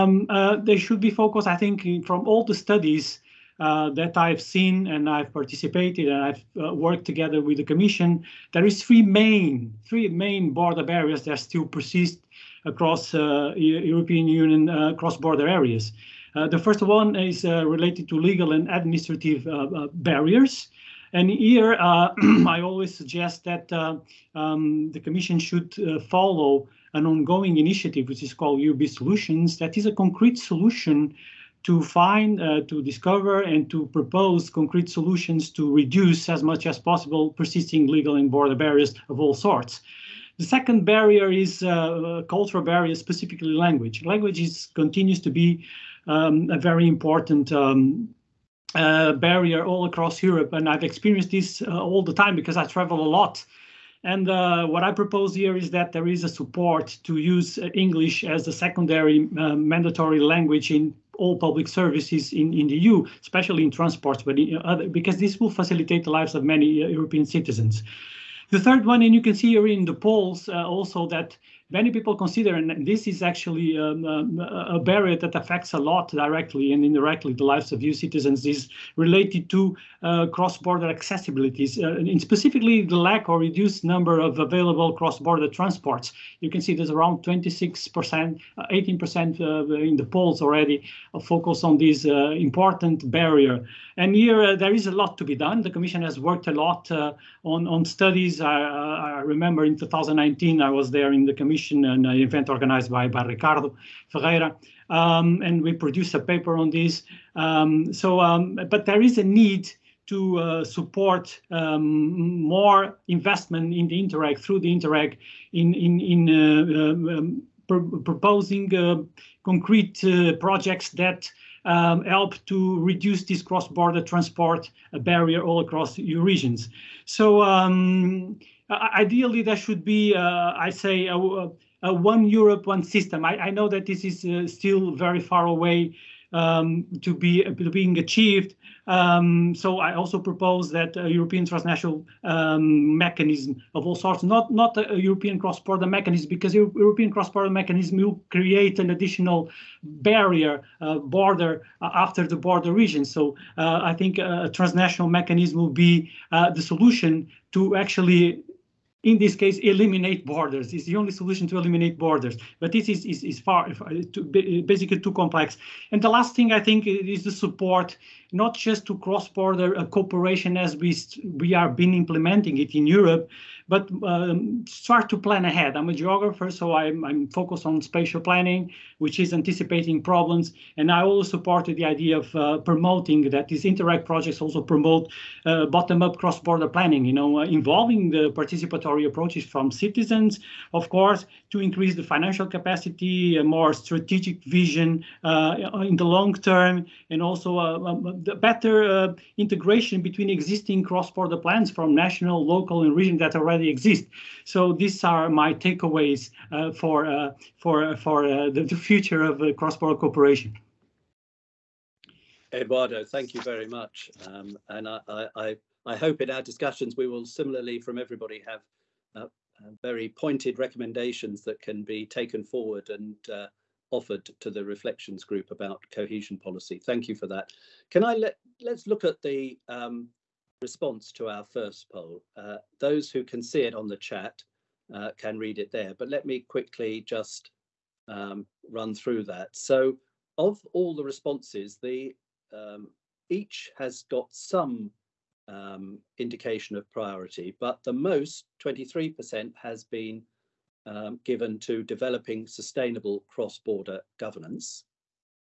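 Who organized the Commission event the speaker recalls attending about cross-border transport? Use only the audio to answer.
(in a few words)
Ricardo Ferreira.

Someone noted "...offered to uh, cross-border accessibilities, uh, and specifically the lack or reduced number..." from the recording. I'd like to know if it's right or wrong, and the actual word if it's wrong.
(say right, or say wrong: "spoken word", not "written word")
wrong: "related", not "offered".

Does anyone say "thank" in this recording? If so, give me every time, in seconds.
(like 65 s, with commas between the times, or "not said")
213 s, 226 s.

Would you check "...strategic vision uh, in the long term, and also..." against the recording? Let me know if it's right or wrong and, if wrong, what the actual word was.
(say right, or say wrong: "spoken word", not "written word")
right.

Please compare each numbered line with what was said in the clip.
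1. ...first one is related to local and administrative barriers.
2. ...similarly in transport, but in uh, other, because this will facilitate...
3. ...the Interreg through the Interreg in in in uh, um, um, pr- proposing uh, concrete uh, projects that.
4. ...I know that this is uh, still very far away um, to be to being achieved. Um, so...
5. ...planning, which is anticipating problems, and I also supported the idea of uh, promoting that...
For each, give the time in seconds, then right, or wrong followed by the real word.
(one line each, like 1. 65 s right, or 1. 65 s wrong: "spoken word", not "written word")
1. 16 s wrong: "legal", not "local"
2. 63 s wrong: "especially", not "similarly"
3. 113 s right
4. 133 s right
5. 178 s right.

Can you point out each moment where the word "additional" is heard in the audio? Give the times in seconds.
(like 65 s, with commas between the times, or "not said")
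148 s.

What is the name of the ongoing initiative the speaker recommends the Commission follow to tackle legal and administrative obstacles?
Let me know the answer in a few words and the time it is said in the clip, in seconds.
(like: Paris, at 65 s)
UB Solutions, at 28 s.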